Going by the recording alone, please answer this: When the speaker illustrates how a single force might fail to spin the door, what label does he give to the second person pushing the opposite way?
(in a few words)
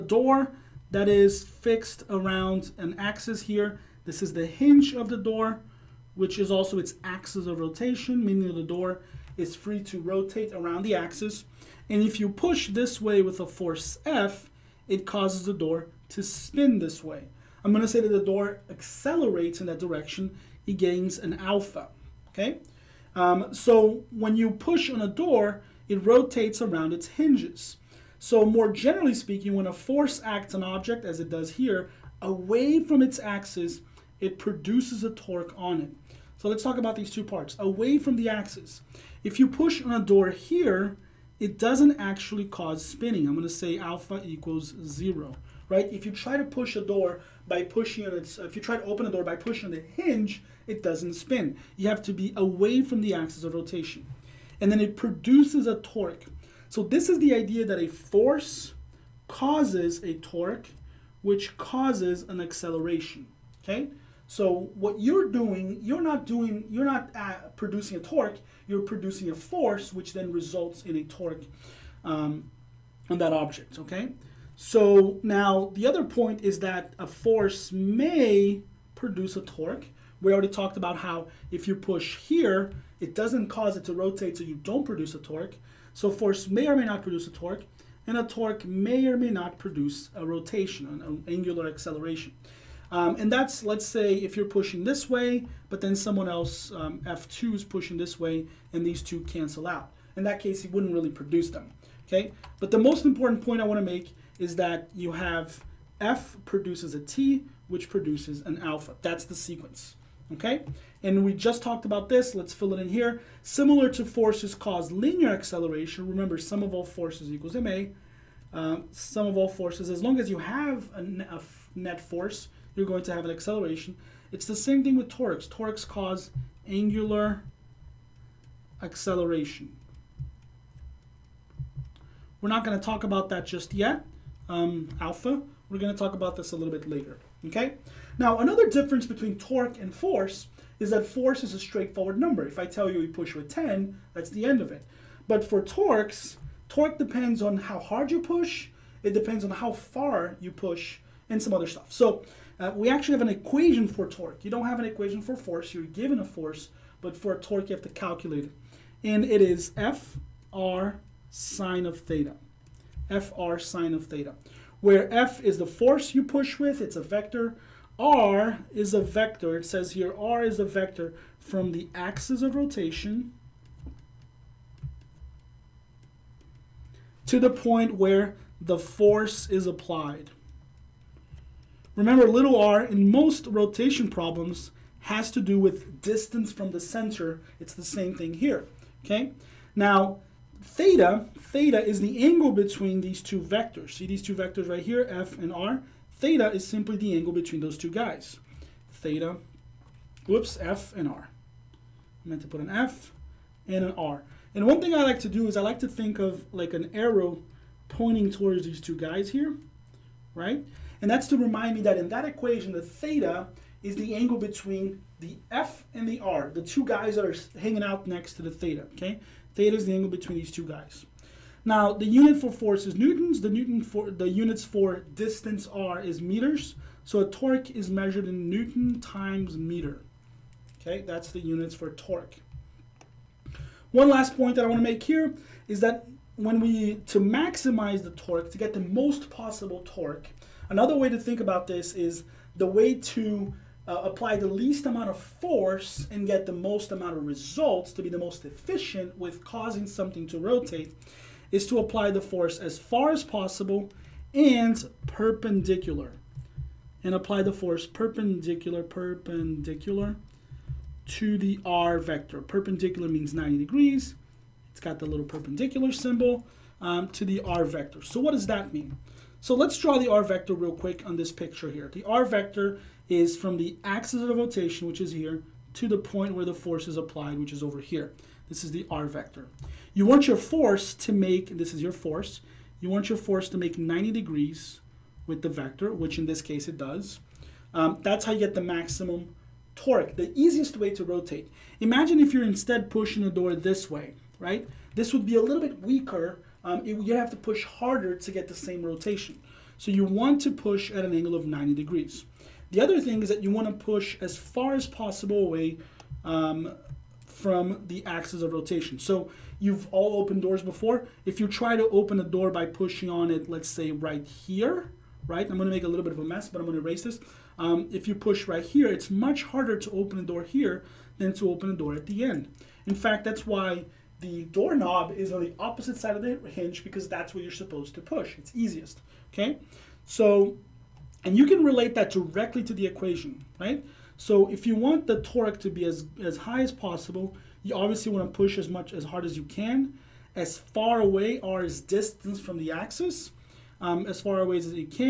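F2.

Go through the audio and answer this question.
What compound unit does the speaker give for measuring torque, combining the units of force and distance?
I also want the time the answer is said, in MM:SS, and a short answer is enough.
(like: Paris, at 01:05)
newton times meter, at 03:48.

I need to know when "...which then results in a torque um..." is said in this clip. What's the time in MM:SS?
01:09.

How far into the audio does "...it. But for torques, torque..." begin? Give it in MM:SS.
02:24.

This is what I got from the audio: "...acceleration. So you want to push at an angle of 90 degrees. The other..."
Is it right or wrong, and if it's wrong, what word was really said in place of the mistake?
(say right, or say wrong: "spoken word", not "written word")
wrong: "rotation", not "acceleration".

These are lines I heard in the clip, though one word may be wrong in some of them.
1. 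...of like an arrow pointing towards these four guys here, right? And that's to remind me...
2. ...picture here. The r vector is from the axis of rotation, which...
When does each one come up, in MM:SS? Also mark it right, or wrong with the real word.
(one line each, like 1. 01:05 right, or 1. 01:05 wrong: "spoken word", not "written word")
1. 03:26 wrong: "two", not "four"
2. 04:31 right.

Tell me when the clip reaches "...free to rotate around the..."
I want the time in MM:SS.
00:09.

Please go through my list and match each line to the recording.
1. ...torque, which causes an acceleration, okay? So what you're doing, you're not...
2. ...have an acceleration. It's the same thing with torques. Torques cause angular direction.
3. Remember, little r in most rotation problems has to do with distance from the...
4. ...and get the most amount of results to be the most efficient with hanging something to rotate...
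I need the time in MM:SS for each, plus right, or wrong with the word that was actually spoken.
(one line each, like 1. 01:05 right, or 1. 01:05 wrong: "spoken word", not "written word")
1. 01:00 right
2. 02:03 wrong: "acceleration", not "direction"
3. 03:01 right
4. 04:06 wrong: "causing", not "hanging".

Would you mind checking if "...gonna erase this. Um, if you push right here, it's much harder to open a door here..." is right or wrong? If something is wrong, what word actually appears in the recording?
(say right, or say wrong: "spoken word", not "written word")
right.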